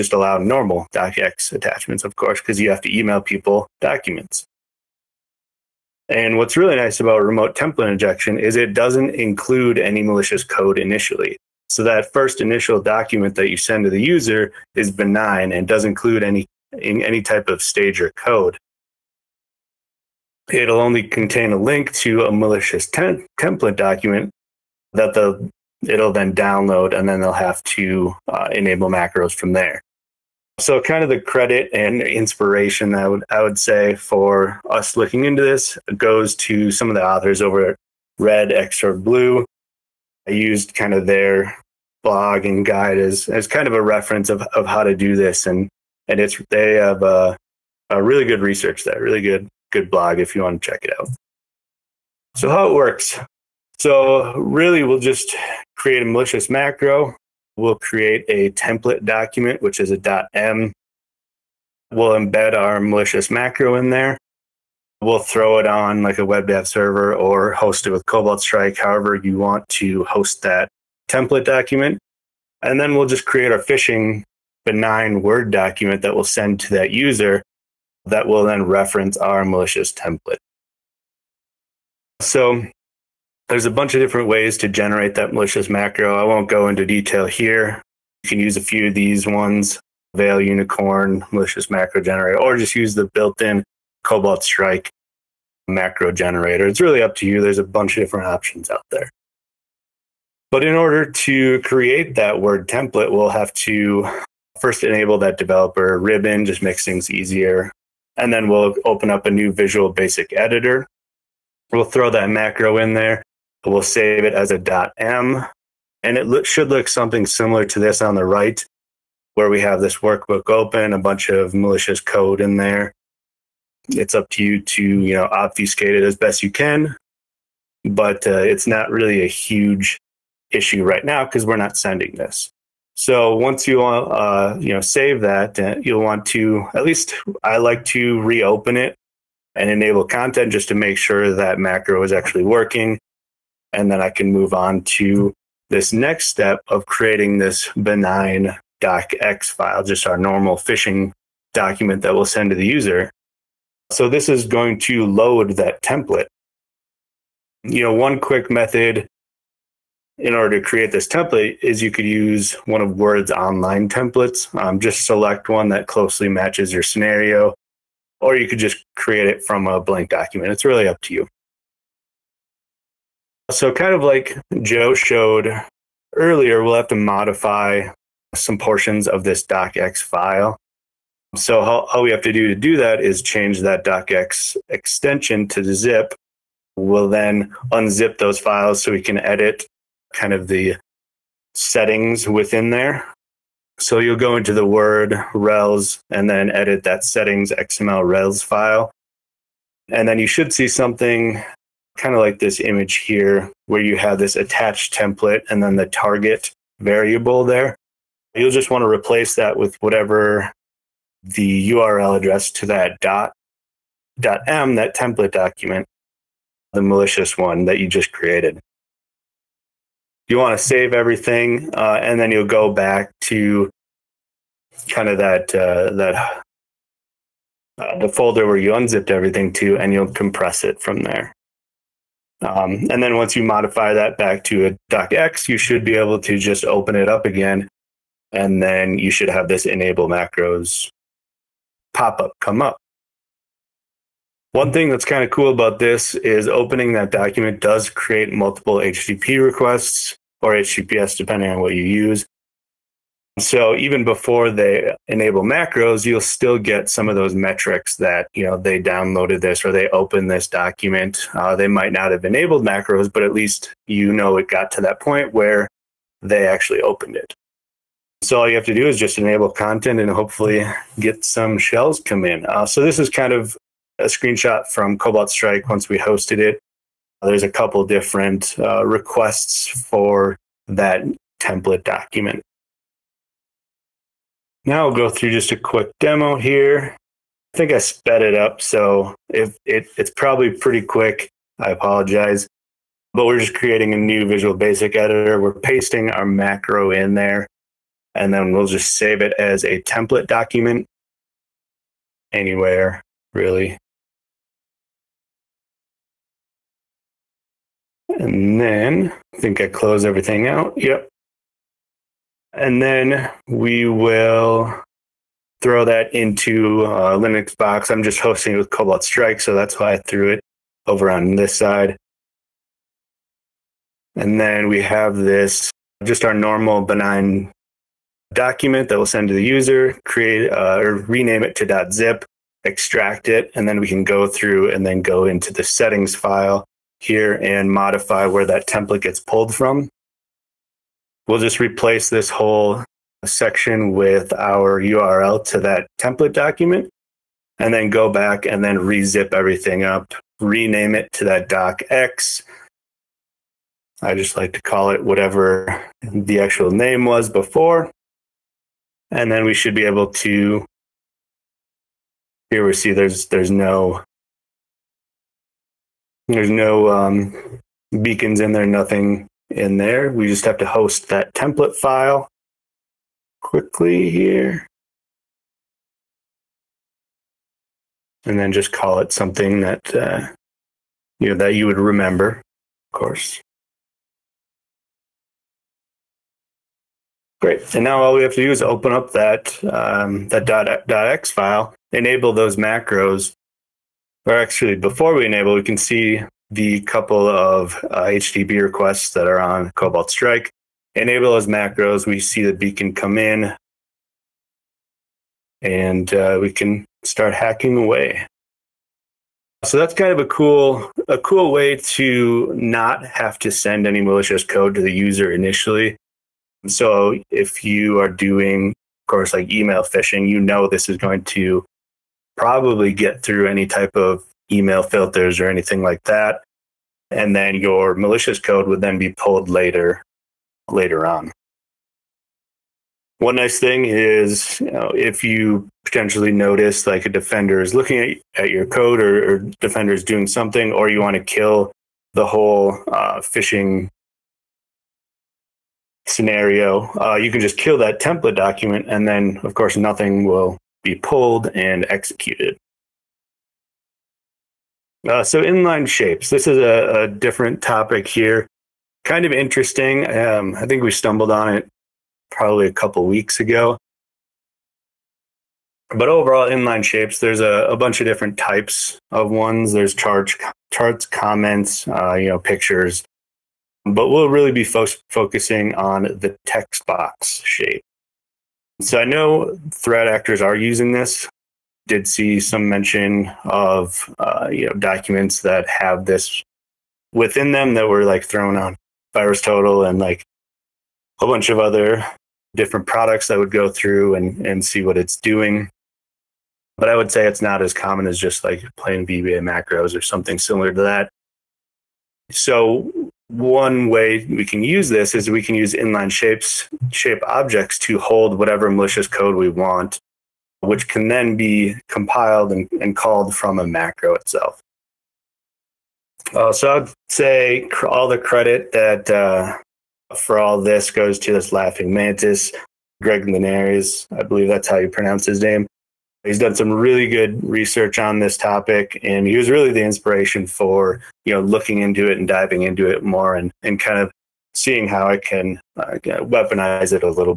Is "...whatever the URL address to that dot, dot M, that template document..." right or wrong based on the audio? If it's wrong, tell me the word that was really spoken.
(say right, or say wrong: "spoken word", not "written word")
right.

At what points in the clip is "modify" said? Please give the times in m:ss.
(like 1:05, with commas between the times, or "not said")
2:56, 3:53, 5:37.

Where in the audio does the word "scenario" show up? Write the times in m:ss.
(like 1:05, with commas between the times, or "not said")
2:46, 7:26.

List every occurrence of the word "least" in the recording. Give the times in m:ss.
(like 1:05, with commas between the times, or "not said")
2:16, 4:23.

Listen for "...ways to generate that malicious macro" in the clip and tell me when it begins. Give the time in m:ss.
1:24.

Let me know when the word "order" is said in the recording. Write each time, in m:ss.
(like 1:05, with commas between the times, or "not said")
1:40, 2:40.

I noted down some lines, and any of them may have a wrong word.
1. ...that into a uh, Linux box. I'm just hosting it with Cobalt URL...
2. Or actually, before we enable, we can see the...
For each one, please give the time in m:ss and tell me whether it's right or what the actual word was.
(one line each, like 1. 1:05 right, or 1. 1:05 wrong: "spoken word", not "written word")
1. 5:15 wrong: "Strike", not "URL"
2. 6:34 right.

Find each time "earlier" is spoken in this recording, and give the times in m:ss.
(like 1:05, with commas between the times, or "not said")
2:56.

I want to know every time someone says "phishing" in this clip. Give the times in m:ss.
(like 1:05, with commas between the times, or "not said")
1:13, 2:30, 6:59, 7:23.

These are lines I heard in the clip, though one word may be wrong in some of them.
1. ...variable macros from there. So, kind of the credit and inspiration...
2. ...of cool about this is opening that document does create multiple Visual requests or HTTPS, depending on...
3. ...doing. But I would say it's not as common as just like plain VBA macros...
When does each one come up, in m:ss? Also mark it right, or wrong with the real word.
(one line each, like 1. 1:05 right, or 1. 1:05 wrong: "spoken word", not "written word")
1. 0:28 wrong: "enable", not "variable"
2. 4:05 wrong: "HTTP", not "Visual"
3. 8:15 right.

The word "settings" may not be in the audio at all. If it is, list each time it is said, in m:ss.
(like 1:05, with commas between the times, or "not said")
3:11, 3:17, 5:35.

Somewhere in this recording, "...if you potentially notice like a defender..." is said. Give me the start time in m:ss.
7:14.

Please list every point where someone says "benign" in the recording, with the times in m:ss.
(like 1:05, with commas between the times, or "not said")
0:14, 1:14, 2:27, 5:26.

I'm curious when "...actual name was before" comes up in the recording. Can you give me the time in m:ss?
5:56.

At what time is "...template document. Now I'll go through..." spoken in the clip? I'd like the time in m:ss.
4:41.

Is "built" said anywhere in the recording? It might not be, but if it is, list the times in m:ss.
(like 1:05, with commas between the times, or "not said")
1:33.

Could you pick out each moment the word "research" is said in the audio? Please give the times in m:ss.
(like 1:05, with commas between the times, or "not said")
0:48, 8:47.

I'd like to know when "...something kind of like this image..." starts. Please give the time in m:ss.
3:20.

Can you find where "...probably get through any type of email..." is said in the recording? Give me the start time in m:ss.
7:02.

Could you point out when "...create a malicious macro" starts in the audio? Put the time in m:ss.
0:55.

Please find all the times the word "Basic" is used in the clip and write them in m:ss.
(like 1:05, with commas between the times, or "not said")
1:49, 4:54.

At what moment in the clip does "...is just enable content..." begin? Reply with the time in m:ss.
4:28.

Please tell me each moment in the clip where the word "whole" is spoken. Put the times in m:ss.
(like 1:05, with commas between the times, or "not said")
5:42, 7:22.